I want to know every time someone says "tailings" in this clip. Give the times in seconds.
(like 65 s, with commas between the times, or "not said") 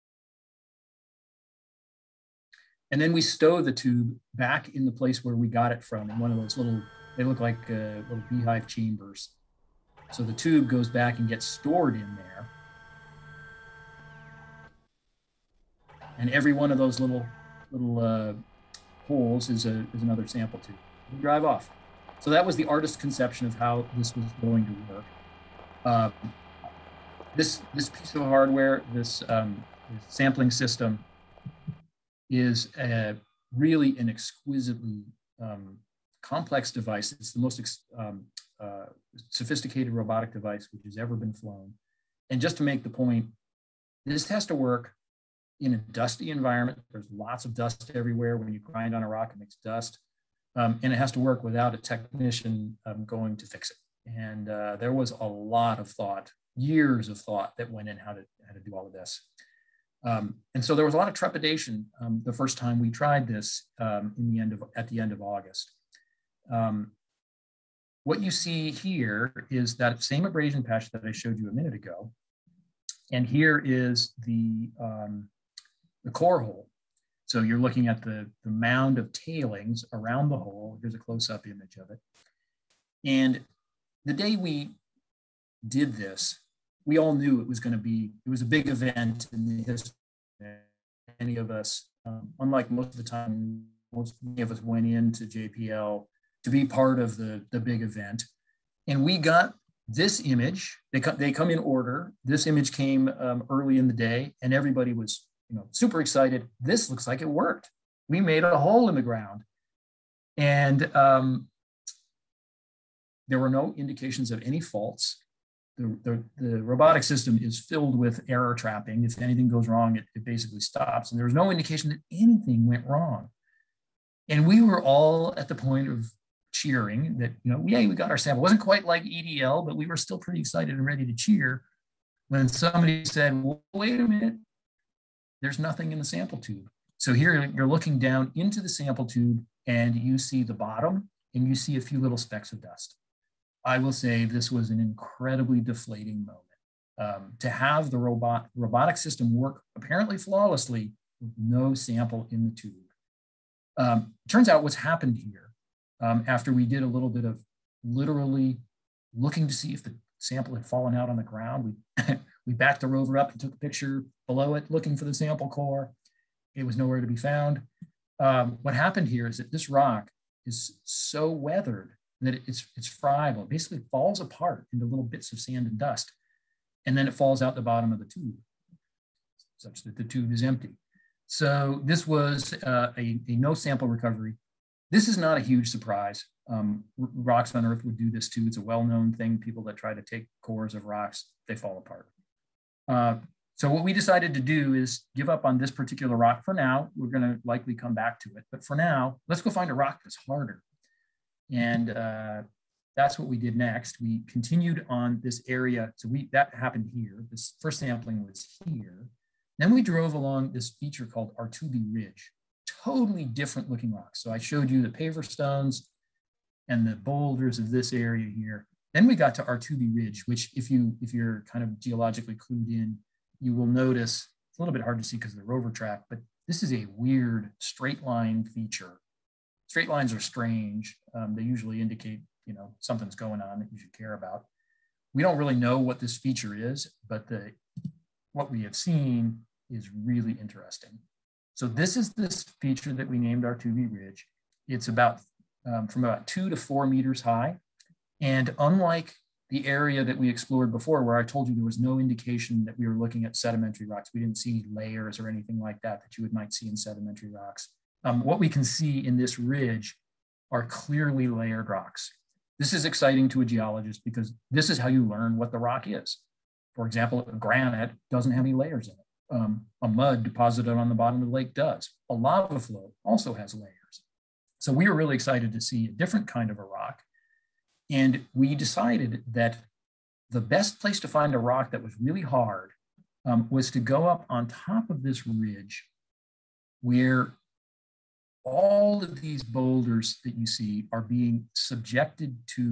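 79 s.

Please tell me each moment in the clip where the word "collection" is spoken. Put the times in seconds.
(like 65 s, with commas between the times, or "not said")
not said.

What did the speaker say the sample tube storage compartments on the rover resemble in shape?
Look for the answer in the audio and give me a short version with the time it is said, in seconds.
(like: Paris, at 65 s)
Little beehive chambers, at 8 s.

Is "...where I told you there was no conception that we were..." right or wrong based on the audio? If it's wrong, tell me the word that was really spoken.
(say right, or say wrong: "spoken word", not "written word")
wrong: "indication", not "conception".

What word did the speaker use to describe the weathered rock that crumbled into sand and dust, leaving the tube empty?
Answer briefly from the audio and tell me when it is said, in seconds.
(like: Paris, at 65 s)
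Friable, at 172 s.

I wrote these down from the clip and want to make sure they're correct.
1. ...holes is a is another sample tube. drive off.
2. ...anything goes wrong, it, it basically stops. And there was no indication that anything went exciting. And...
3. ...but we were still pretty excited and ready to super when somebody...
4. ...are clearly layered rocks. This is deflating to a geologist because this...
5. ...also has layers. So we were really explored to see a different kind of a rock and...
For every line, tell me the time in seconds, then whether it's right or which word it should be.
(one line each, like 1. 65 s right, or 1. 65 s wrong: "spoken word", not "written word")
1. 19 s right
2. 119 s wrong: "wrong", not "exciting"
3. 129 s wrong: "cheer", not "super"
4. 260 s wrong: "exciting", not "deflating"
5. 273 s wrong: "excited", not "explored".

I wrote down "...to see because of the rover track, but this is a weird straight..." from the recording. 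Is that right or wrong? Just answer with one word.
right.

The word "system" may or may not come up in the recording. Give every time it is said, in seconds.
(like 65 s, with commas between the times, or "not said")
30 s, 117 s, 148 s.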